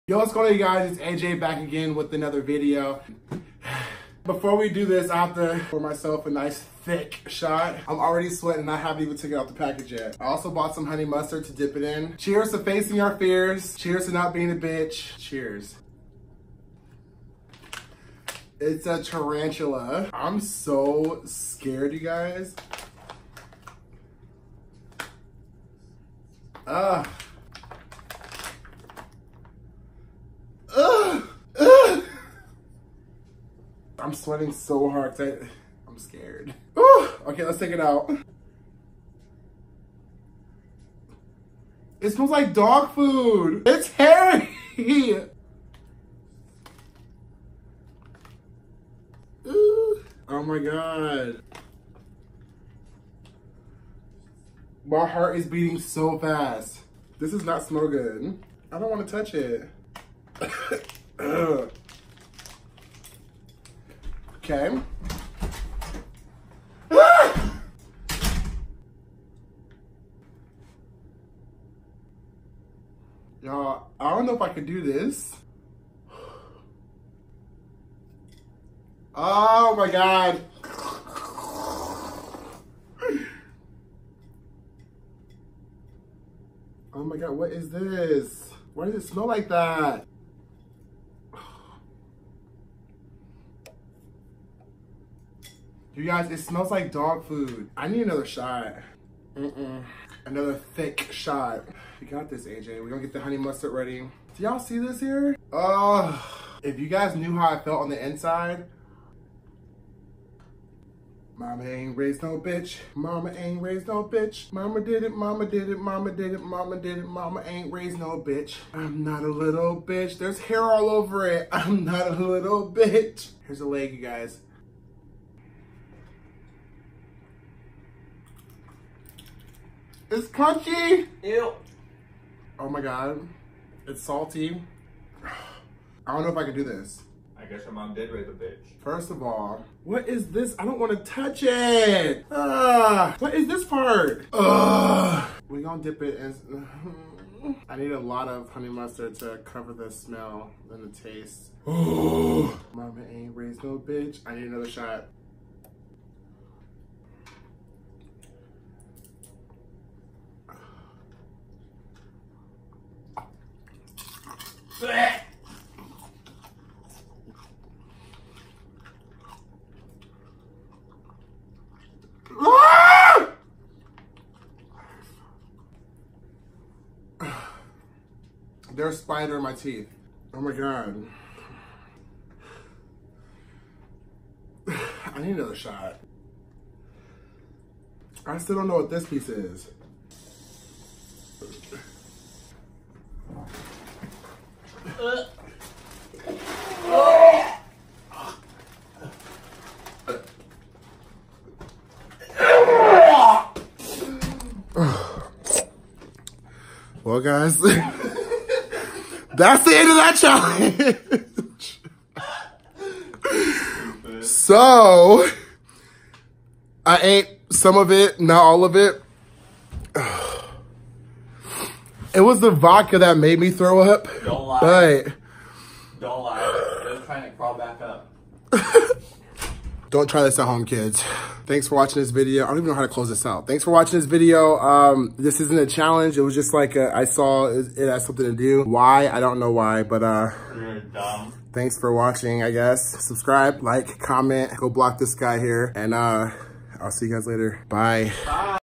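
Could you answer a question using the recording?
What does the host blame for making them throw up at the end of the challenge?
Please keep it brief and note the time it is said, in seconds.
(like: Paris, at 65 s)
the vodka, at 222 s.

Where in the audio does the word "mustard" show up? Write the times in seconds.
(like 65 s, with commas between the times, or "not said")
11 s, 103 s, 148 s.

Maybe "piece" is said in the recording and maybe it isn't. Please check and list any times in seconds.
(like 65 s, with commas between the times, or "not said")
189 s.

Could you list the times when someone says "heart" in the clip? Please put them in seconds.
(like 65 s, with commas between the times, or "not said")
55 s.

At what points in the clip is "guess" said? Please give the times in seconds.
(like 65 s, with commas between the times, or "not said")
137 s, 242 s.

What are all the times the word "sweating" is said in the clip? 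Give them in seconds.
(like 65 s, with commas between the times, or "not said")
8 s, 34 s.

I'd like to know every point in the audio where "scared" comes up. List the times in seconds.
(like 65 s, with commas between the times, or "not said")
21 s, 35 s.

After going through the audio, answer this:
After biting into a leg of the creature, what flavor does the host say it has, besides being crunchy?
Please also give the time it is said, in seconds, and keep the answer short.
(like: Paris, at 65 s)
salty, at 134 s.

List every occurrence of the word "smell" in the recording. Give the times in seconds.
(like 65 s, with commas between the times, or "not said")
42 s, 57 s, 89 s, 96 s, 149 s.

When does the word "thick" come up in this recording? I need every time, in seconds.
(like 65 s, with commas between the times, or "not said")
6 s, 100 s.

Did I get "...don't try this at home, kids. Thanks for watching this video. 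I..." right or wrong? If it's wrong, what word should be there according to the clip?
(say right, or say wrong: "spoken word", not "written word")
right.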